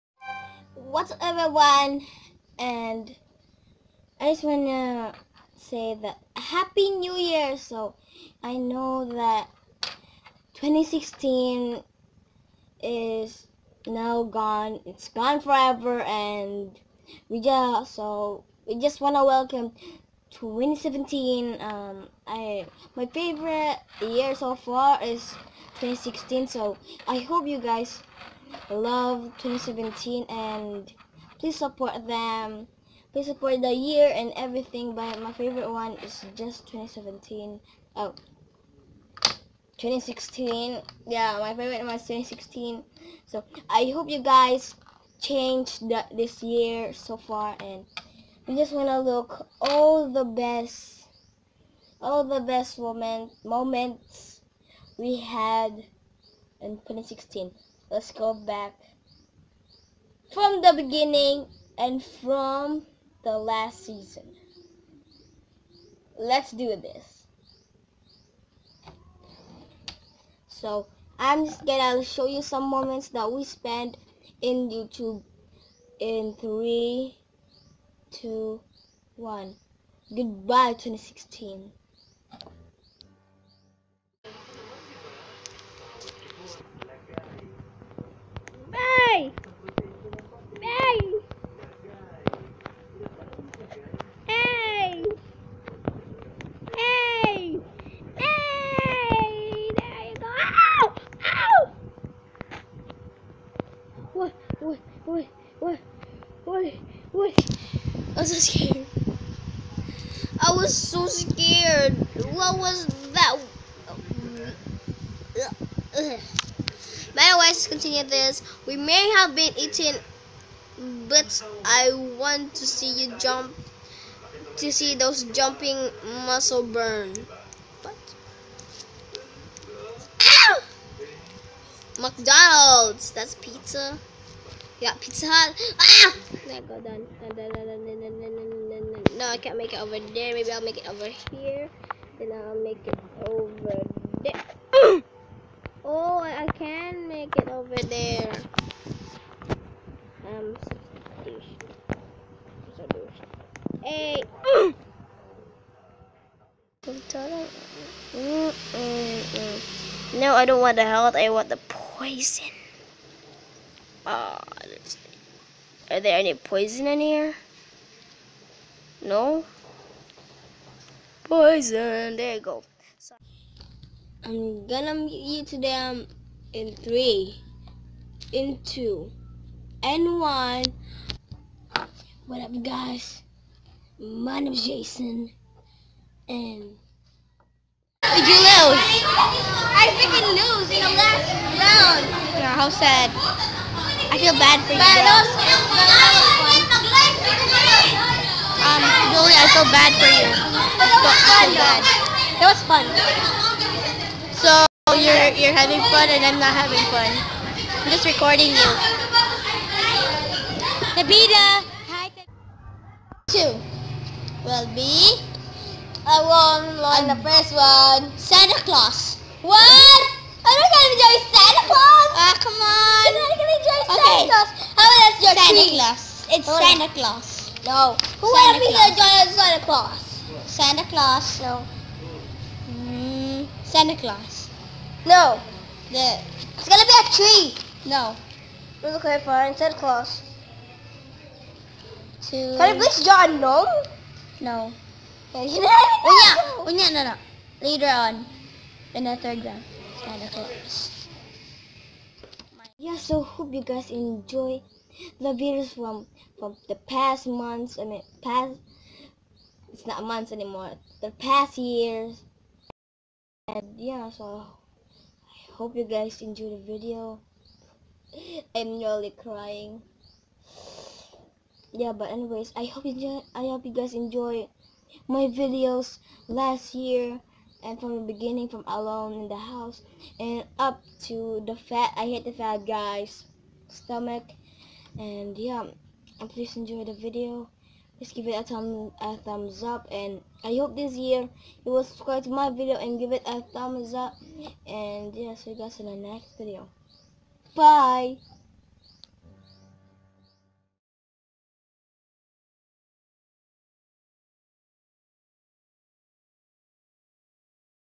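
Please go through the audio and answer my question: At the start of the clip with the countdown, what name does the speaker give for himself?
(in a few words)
Jason.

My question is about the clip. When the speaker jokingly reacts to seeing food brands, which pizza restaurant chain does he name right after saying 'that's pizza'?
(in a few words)
Pizza Hut.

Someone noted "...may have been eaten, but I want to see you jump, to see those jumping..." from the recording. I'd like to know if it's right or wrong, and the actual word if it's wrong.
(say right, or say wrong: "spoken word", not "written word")
right.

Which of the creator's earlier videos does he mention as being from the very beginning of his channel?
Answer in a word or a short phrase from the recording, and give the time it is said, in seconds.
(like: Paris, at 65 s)
Alone in the House, at 278 s.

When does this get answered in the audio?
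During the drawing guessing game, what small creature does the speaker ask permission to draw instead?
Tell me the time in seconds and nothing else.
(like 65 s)
243 s.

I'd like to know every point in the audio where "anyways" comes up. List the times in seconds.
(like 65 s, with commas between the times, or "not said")
117 s, 272 s.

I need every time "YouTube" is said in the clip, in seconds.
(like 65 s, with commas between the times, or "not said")
74 s.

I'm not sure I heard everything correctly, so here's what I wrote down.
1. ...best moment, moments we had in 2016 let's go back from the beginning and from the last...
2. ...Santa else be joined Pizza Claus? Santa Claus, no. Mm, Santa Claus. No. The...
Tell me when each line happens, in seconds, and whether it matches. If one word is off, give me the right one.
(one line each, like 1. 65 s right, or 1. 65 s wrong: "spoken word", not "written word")
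1. 52 s right
2. 228 s wrong: "Santa", not "Pizza".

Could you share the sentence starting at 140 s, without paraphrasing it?
Maybe I'll make it over here.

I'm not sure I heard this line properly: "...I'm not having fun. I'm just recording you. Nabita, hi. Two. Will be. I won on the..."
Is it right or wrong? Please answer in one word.
right.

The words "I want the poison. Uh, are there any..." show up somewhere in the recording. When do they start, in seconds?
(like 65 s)
161 s.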